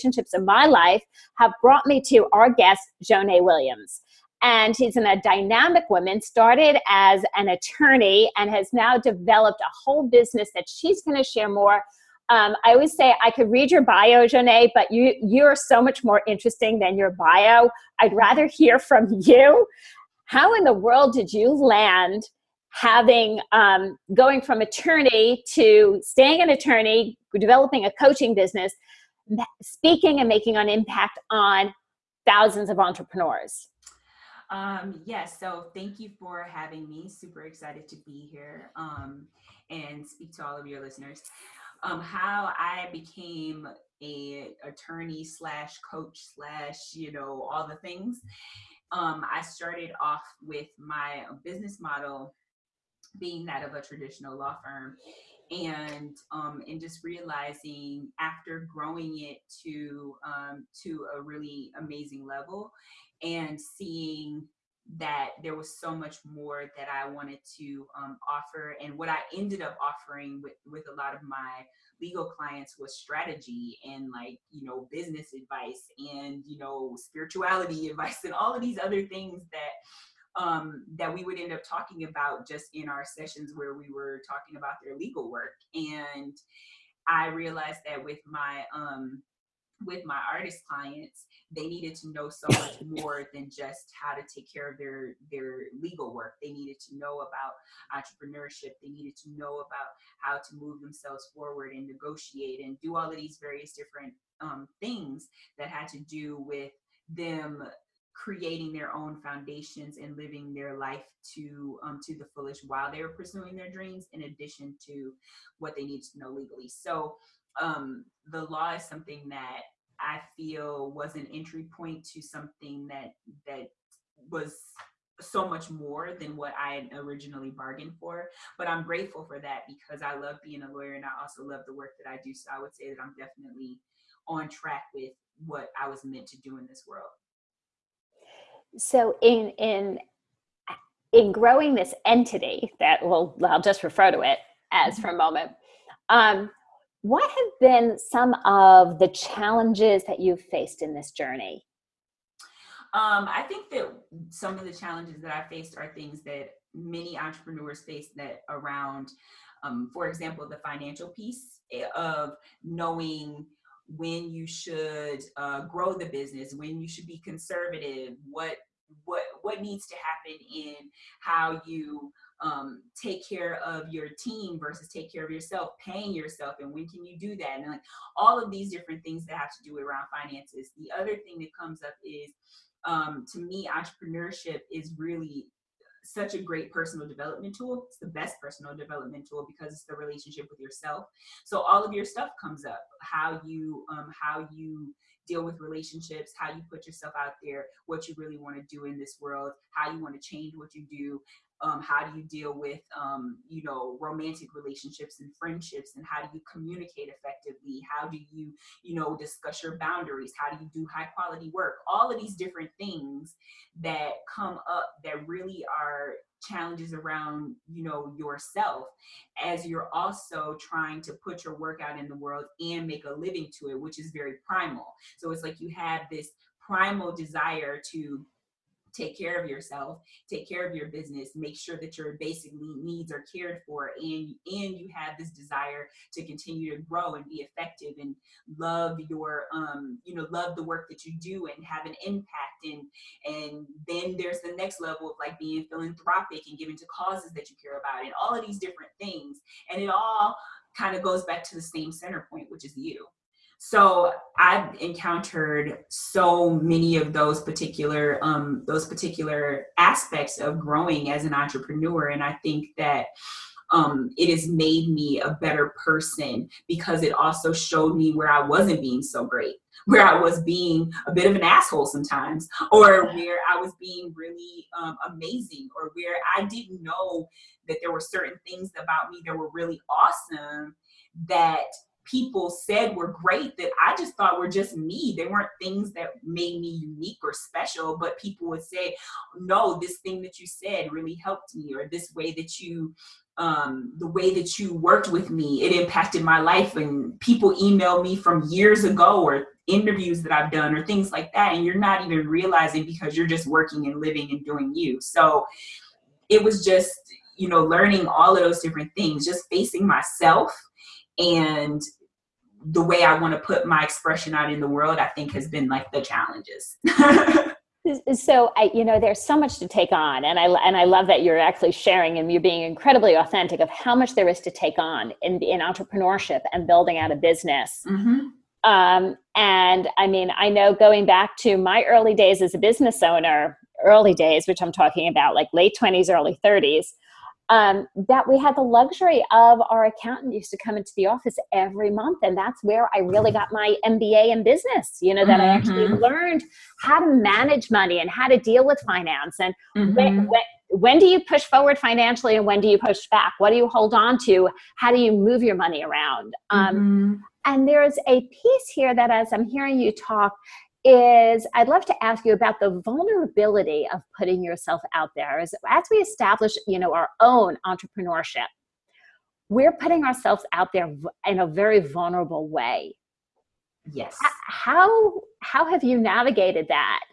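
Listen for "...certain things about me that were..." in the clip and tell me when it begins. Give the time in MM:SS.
04:37.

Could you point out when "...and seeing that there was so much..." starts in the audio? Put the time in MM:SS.
01:03.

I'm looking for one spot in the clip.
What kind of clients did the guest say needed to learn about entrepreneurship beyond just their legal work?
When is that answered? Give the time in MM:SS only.
01:30.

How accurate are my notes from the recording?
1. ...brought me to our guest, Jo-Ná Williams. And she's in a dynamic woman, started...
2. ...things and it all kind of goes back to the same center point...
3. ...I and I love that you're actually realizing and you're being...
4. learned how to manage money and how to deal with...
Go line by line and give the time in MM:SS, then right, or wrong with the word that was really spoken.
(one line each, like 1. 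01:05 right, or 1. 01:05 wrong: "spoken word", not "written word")
1. 00:01 right
2. 04:08 right
3. 05:20 wrong: "sharing", not "realizing"
4. 05:46 right.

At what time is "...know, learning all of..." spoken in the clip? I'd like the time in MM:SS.
05:07.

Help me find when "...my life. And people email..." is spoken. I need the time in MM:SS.
04:56.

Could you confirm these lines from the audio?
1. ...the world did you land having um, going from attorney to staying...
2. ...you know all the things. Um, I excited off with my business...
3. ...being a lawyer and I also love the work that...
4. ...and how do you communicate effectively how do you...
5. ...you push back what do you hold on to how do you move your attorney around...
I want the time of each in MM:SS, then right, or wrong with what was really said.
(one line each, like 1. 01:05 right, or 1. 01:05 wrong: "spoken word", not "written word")
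1. 00:20 right
2. 00:46 wrong: "started", not "excited"
3. 02:10 right
4. 03:25 right
5. 05:52 wrong: "money", not "attorney".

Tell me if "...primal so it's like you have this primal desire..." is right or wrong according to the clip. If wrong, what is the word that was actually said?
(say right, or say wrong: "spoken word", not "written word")
right.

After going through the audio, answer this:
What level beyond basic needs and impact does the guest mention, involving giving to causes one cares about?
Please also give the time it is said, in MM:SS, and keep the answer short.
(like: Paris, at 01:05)
philanthropic, at 04:05.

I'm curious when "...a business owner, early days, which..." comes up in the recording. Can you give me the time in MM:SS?
05:32.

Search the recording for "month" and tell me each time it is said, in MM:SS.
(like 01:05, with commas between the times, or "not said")
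05:41.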